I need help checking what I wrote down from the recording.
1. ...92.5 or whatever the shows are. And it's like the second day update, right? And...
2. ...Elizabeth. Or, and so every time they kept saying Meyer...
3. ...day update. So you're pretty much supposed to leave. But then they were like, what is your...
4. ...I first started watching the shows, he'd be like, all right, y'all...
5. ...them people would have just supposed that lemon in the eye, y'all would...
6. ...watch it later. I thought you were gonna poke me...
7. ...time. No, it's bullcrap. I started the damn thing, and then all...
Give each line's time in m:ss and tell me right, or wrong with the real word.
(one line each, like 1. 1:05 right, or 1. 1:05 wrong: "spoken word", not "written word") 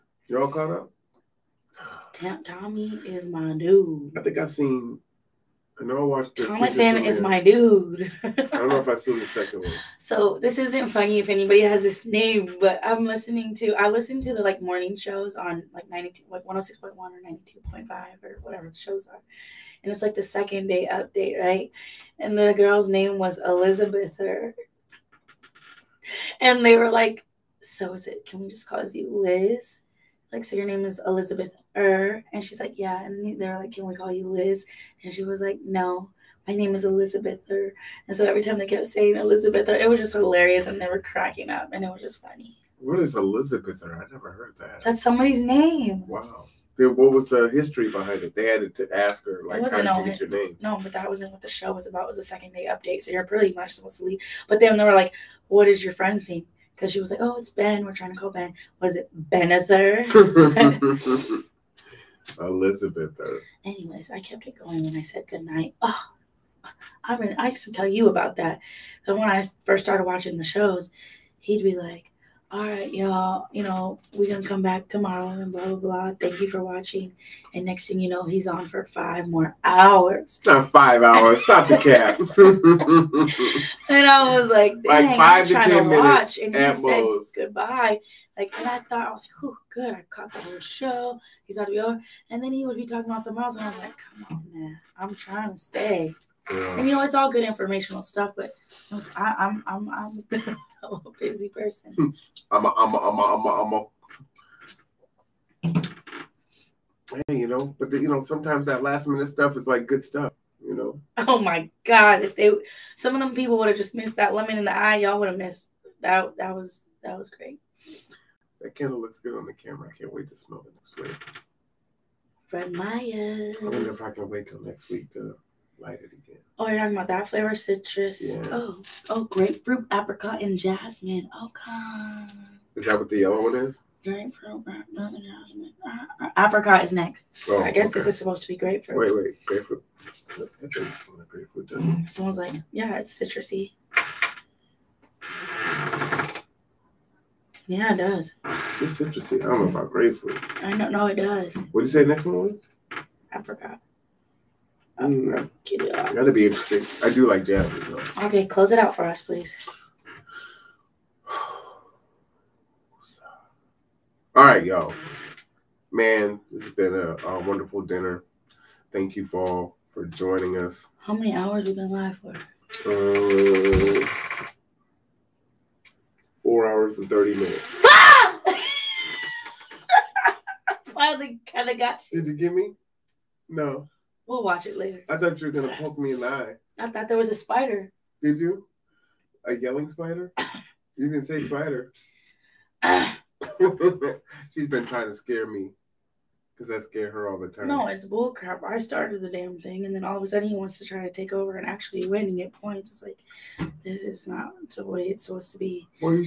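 1. 0:17 right
2. 0:36 wrong: "Elizabeth", not "Meyer"
3. 0:52 right
4. 1:09 right
5. 1:53 wrong: "missed", not "supposed"
6. 3:04 right
7. 3:17 right.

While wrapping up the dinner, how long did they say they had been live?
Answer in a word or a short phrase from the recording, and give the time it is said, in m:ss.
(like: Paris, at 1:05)
4 hours and 30 minutes, at 2:56.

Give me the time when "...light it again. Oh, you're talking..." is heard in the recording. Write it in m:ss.
2:05.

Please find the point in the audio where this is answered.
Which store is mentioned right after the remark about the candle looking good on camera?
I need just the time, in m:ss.
2:02.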